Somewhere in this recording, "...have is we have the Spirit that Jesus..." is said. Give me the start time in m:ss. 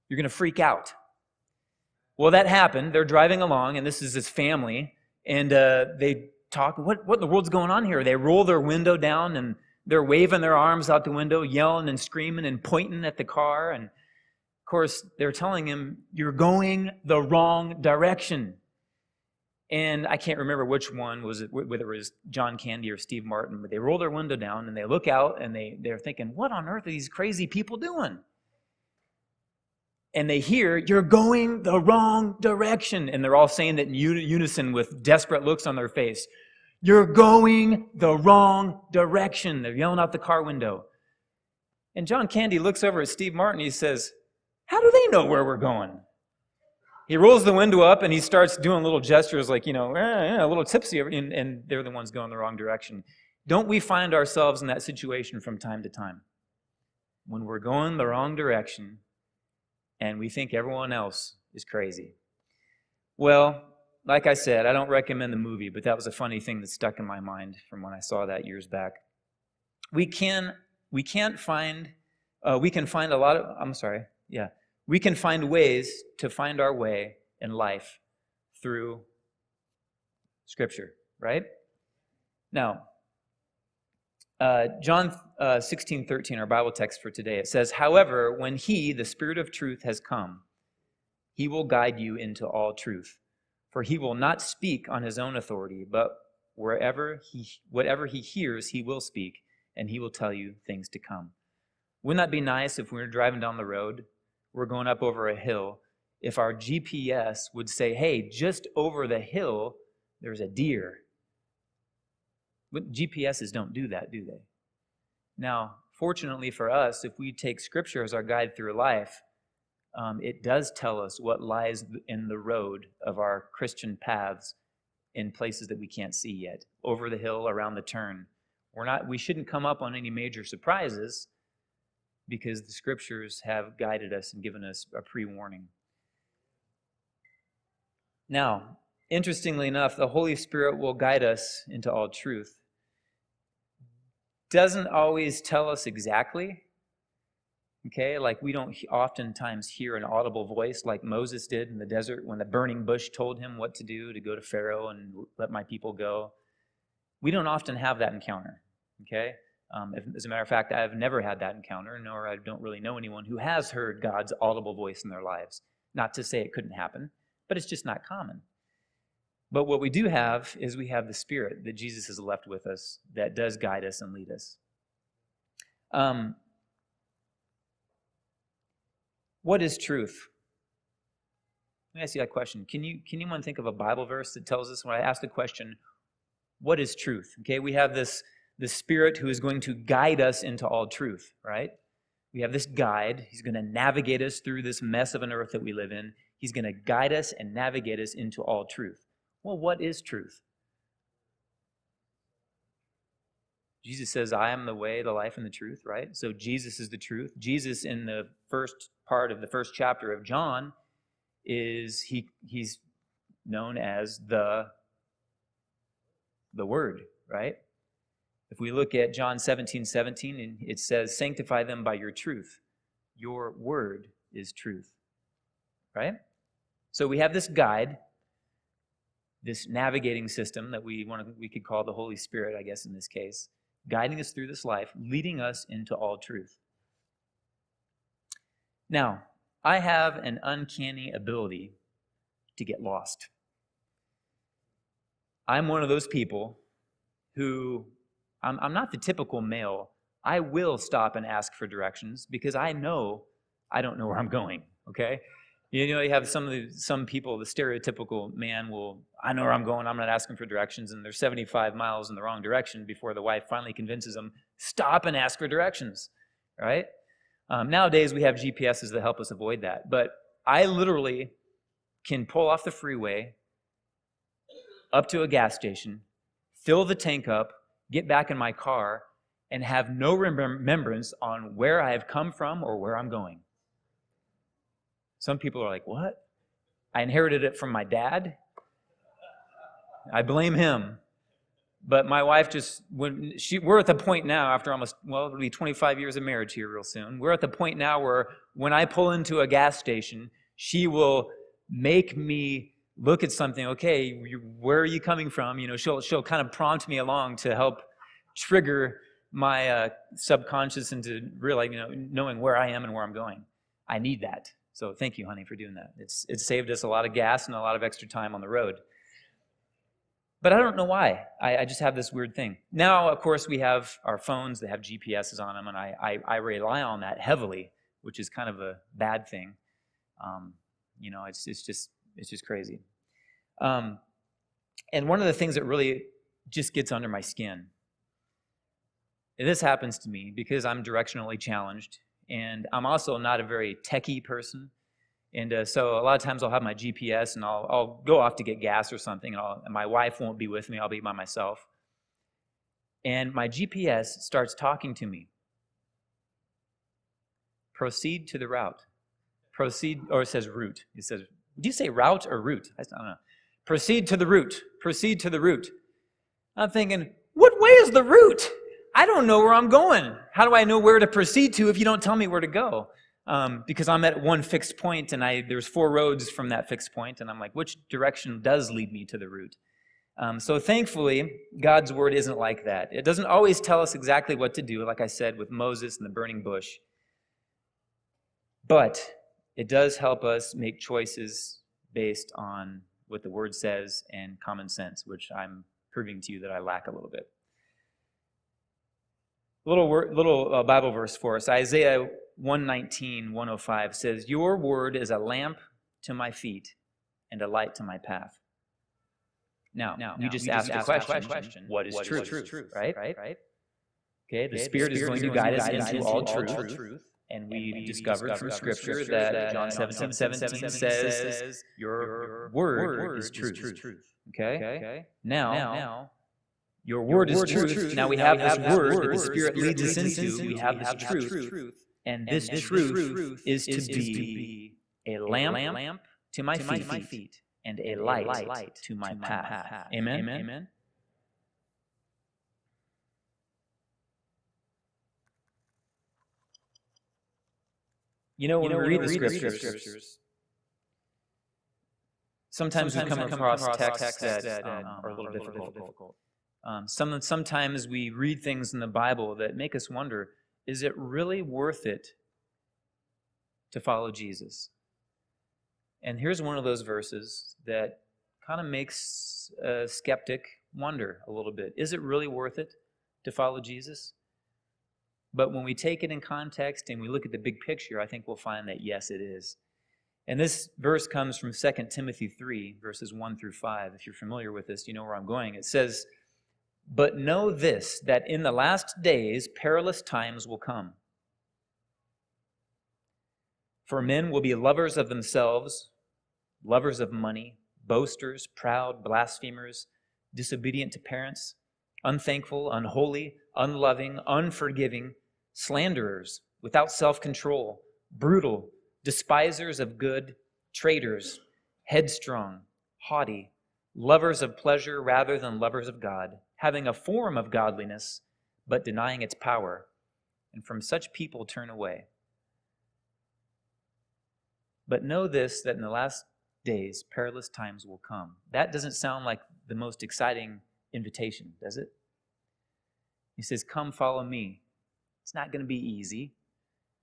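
2:50.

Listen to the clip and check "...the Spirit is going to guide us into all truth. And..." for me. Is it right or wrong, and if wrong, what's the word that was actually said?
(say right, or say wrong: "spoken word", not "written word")
right.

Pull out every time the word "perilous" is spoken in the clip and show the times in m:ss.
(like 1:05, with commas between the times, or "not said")
8:09, 8:47.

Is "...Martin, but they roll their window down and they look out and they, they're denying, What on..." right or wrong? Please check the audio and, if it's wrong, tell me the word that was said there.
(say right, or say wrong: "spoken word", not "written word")
wrong: "thinking", not "denying".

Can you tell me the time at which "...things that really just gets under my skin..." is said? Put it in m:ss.
5:35.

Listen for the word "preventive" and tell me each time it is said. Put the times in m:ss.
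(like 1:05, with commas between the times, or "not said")
not said.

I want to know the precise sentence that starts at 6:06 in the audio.
I'm thinking, what way is the route?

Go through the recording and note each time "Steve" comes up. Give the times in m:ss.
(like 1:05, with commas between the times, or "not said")
0:22, 0:43.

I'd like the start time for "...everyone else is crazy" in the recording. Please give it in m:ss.
1:00.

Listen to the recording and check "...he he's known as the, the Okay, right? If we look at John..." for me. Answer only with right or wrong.
wrong.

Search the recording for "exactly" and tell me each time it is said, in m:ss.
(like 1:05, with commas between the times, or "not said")
2:25, 6:23.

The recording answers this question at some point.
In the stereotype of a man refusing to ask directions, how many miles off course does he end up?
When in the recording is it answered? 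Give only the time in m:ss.
4:21.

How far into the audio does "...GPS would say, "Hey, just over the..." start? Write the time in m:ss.
1:46.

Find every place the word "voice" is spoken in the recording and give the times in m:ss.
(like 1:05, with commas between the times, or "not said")
2:30, 2:44.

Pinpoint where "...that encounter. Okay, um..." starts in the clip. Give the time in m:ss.
2:37.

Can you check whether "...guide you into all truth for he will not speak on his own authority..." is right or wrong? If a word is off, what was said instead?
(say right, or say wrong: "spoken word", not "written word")
right.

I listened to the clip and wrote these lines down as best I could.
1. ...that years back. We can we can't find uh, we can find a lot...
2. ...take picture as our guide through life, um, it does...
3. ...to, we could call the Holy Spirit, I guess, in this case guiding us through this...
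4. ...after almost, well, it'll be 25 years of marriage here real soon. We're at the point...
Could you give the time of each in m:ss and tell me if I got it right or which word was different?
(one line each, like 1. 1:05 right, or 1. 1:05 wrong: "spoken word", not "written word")
1. 1:08 right
2. 1:57 wrong: "scripture", not "picture"
3. 3:51 right
4. 4:54 right.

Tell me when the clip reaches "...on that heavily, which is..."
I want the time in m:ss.
5:26.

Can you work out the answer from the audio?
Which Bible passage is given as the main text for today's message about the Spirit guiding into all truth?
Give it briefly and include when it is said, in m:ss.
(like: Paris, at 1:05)
John 16:13, at 1:24.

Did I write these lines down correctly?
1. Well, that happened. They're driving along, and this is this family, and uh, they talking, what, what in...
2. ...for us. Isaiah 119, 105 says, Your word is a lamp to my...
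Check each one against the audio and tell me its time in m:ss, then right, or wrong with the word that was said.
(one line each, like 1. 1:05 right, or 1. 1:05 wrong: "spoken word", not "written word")
1. 0:02 right
2. 6:41 right.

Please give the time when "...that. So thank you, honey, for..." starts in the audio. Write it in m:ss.
5:14.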